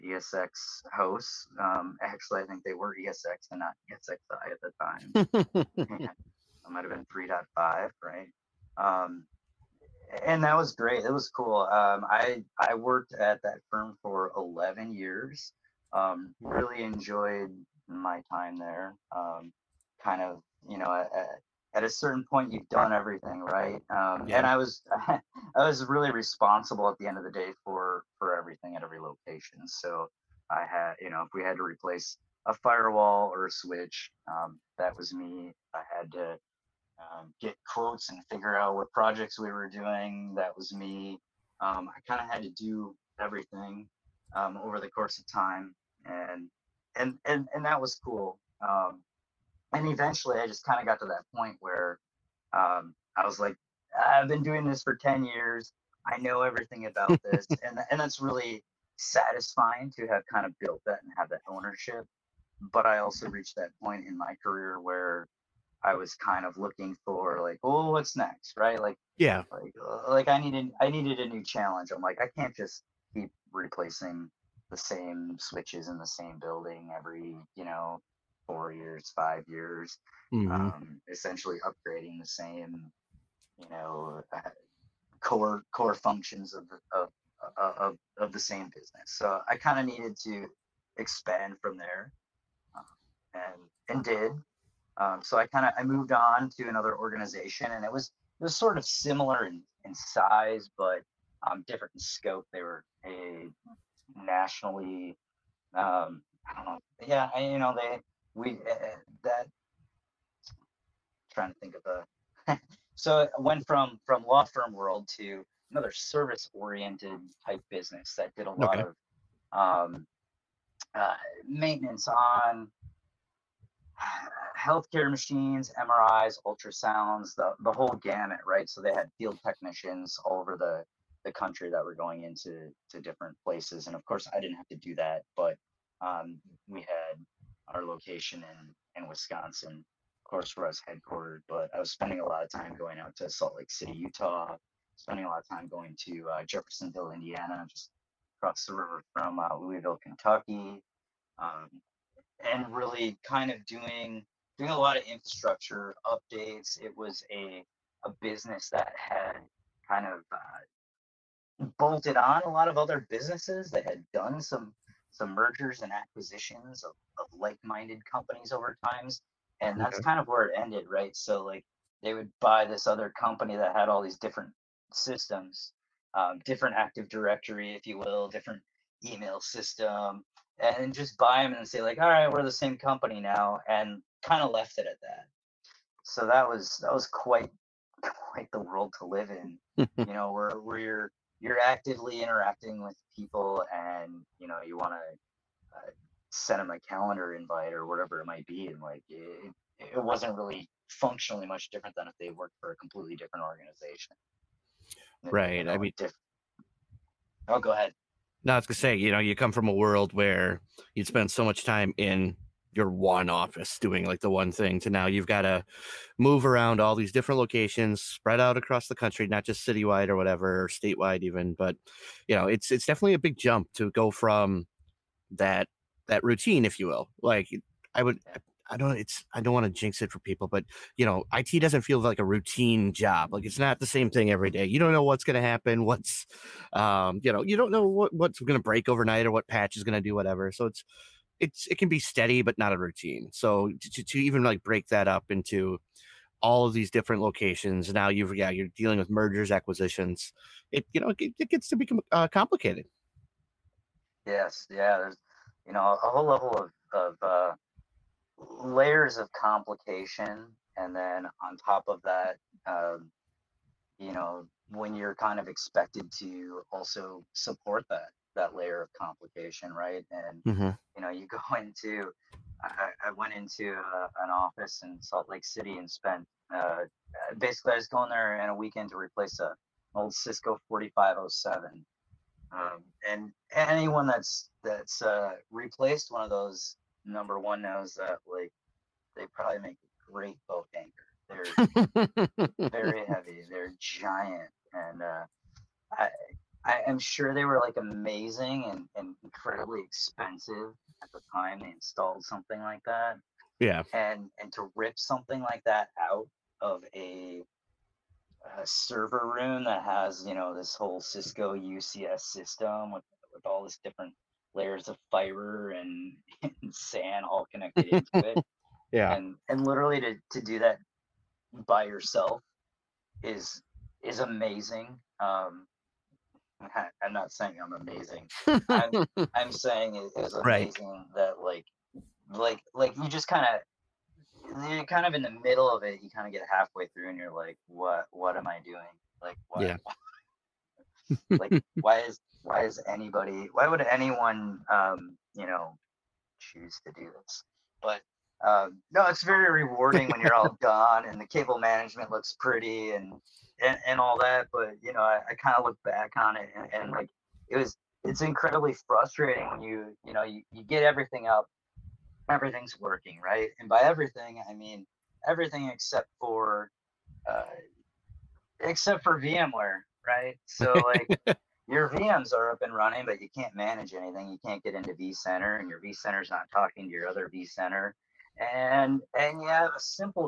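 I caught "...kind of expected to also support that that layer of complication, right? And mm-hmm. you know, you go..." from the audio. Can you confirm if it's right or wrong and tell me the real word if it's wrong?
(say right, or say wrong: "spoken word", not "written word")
right.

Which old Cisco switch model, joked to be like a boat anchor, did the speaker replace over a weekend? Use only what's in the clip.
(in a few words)
Cisco 4507.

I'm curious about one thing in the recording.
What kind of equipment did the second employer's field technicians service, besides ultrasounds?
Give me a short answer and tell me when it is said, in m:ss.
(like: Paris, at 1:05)
MRIs, at 2:05.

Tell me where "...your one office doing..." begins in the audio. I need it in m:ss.
3:32.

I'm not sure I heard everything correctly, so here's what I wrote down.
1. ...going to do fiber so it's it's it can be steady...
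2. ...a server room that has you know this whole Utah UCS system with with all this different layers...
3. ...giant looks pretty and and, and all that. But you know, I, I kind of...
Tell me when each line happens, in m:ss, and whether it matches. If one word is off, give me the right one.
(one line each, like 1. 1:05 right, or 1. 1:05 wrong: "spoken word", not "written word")
1. 3:59 wrong: "whatever", not "fiber"
2. 5:08 wrong: "Cisco", not "Utah"
3. 5:51 wrong: "management", not "giant".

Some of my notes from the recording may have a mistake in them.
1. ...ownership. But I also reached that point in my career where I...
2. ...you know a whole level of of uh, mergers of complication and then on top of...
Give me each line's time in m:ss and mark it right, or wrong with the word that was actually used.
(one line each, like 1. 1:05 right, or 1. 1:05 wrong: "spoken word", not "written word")
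1. 1:01 right
2. 4:15 wrong: "layers", not "mergers".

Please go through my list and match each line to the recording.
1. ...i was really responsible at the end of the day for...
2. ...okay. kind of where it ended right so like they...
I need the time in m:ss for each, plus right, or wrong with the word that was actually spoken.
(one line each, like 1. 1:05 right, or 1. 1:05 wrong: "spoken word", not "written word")
1. 0:25 right
2. 2:49 right.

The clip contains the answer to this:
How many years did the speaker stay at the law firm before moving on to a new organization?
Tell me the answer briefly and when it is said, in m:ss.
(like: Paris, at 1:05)
11, at 0:14.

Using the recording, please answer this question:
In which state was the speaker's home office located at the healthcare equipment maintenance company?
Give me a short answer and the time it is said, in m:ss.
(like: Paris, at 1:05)
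Wisconsin, at 2:19.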